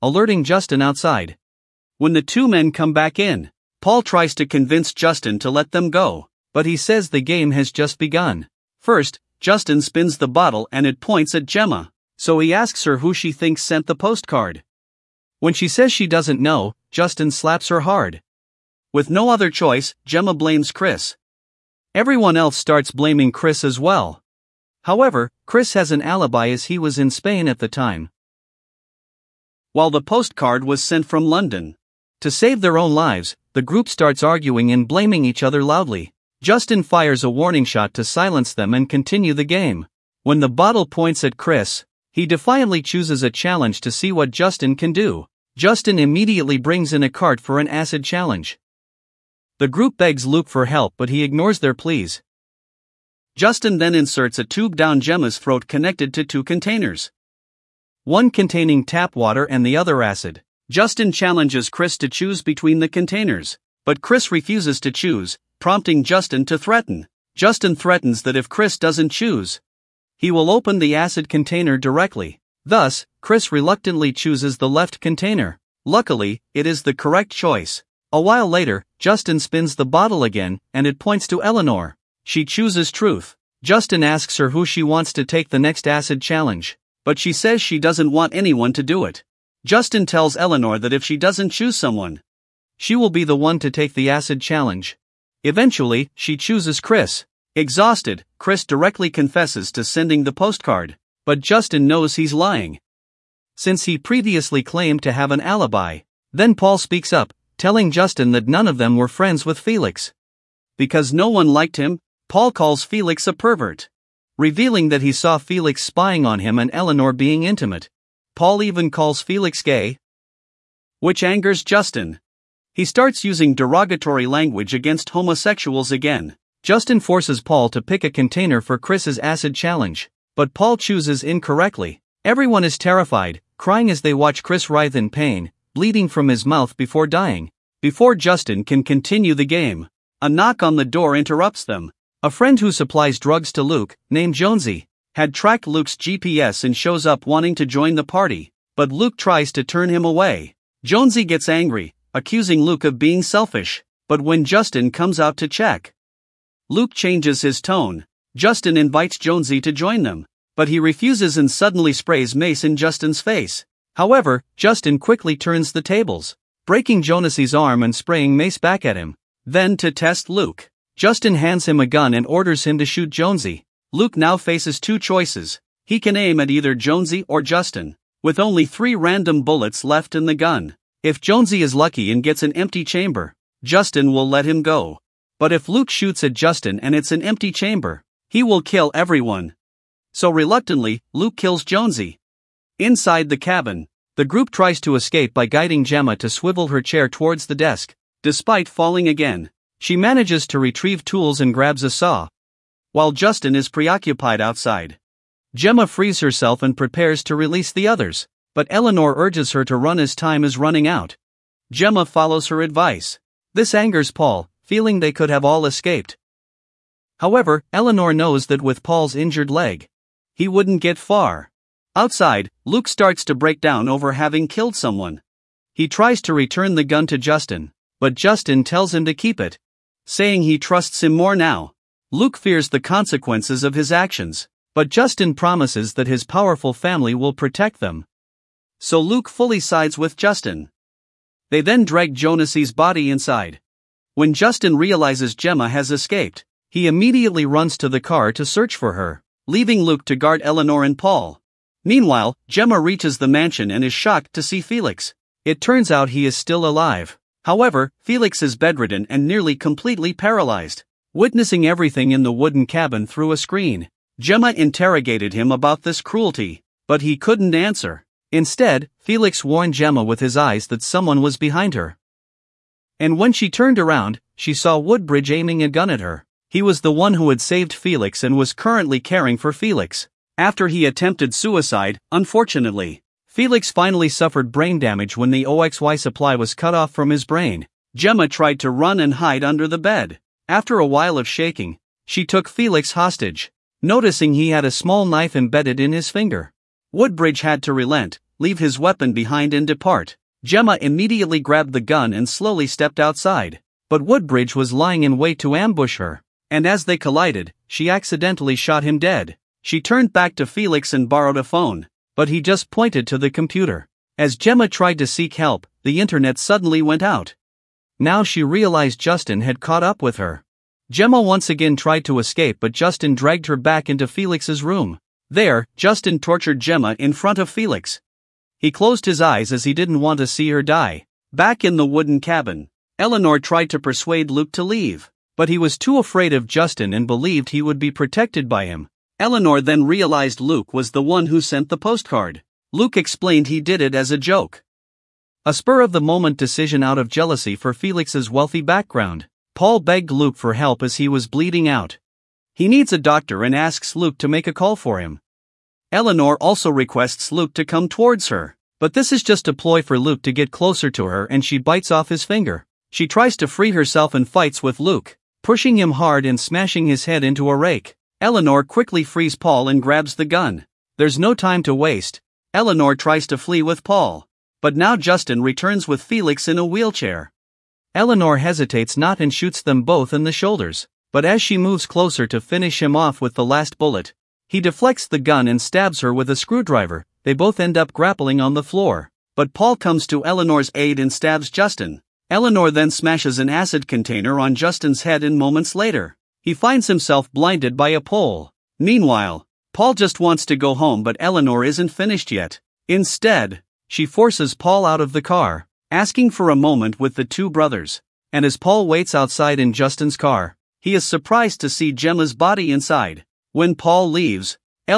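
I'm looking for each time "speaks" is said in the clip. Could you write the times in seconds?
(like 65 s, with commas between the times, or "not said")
106 s.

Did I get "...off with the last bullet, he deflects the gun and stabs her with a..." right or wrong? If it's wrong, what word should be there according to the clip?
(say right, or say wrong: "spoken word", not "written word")
right.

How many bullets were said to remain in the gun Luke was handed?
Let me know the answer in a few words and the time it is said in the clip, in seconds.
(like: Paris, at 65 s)
3, at 178 s.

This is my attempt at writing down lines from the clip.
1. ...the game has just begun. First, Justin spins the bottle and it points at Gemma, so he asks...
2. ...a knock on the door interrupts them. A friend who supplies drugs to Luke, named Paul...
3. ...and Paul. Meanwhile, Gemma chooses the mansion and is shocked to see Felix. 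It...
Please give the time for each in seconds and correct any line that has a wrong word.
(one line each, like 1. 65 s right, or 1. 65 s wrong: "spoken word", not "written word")
1. 7 s right
2. 140 s wrong: "Jonesy", not "Paul"
3. 250 s wrong: "reaches", not "chooses".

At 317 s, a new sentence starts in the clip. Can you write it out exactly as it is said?
Now she realized Justin had caught up with her.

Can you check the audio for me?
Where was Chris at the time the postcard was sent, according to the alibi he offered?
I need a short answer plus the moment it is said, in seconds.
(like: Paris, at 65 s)
Spain, at 27 s.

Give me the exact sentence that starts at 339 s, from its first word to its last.
Eleanor then realized Luke was the one who sent the postcard.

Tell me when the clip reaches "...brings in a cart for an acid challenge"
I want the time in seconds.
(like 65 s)
46 s.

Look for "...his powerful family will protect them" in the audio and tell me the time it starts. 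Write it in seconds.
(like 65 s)
236 s.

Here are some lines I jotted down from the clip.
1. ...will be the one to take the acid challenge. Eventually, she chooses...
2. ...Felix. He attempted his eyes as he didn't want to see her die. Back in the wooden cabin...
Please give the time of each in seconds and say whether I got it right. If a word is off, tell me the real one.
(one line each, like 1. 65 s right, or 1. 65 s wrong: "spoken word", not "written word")
1. 92 s right
2. 327 s wrong: "closed", not "attempted".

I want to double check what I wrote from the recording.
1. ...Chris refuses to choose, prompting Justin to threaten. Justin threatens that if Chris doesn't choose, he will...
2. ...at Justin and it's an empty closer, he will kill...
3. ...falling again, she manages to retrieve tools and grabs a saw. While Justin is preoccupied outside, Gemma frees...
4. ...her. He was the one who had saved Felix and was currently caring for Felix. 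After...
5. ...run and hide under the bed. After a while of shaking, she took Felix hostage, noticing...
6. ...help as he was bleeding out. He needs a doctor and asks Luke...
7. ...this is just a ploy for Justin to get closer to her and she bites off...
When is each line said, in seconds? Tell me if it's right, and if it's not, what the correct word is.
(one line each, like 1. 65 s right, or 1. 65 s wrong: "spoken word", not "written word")
1. 64 s right
2. 186 s wrong: "chamber", not "closer"
3. 198 s right
4. 276 s right
5. 288 s right
6. 350 s right
7. 358 s wrong: "Luke", not "Justin".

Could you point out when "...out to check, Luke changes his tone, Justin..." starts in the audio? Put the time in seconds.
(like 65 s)
155 s.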